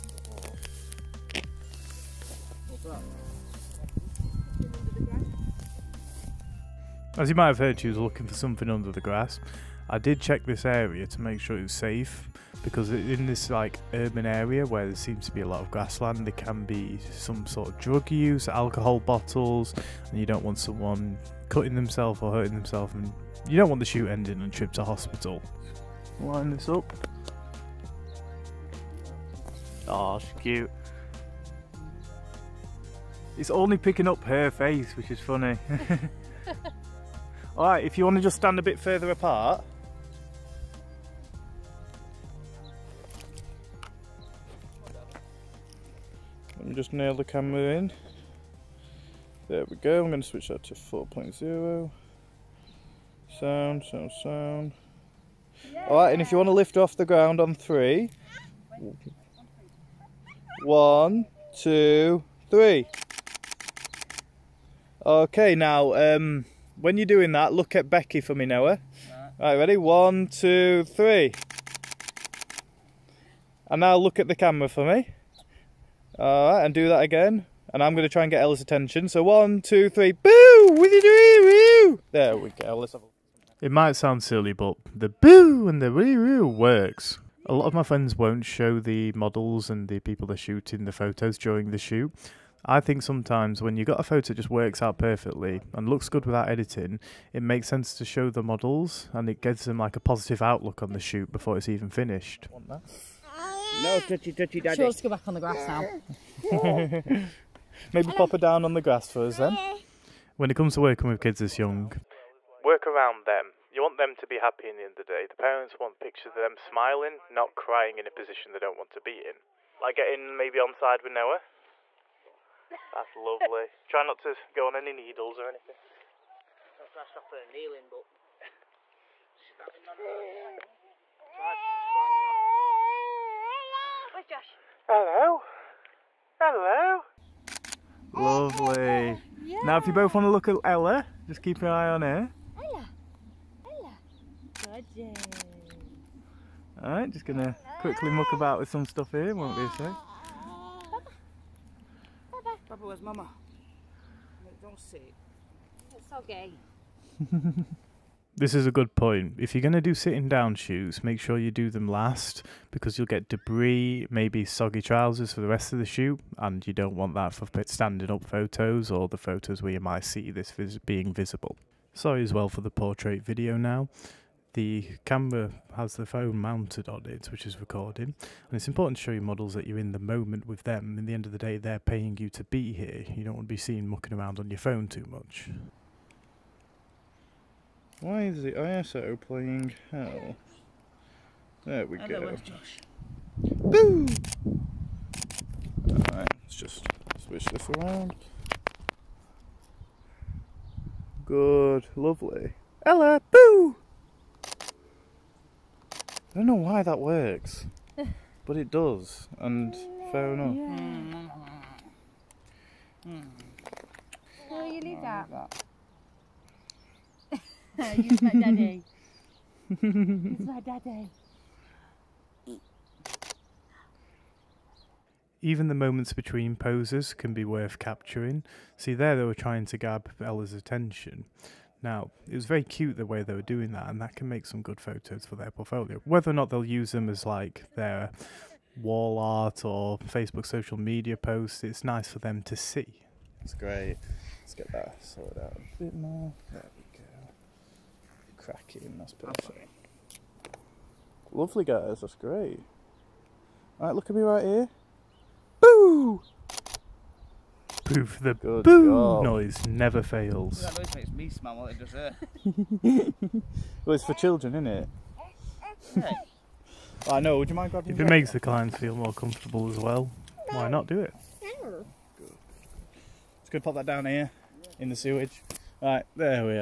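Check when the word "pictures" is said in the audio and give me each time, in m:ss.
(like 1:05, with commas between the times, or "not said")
1:56.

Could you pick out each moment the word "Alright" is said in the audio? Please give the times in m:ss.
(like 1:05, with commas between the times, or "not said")
0:55, 1:16, 3:15.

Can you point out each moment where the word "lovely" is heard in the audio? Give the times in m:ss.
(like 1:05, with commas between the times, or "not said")
2:03, 2:18, 3:21, 4:11.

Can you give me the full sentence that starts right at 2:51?
Sorry as well for the portrait video now.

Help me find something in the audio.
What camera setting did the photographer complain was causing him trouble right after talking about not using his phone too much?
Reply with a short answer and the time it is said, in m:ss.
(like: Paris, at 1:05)
ISO, at 3:08.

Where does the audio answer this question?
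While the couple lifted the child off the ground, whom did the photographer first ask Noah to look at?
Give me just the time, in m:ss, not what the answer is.
1:07.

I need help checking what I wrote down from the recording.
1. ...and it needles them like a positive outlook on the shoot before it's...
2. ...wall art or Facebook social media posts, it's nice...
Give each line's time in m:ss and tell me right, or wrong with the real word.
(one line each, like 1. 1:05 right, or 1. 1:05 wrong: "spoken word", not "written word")
1. 1:39 wrong: "gives", not "needles"
2. 3:58 right.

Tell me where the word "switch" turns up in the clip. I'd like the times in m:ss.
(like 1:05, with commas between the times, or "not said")
0:50, 3:17.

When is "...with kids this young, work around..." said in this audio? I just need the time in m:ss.
1:51.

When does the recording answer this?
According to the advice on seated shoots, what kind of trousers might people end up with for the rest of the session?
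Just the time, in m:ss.
2:44.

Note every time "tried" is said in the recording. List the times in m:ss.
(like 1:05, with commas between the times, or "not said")
2:06.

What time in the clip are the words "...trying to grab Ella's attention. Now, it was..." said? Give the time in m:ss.
3:49.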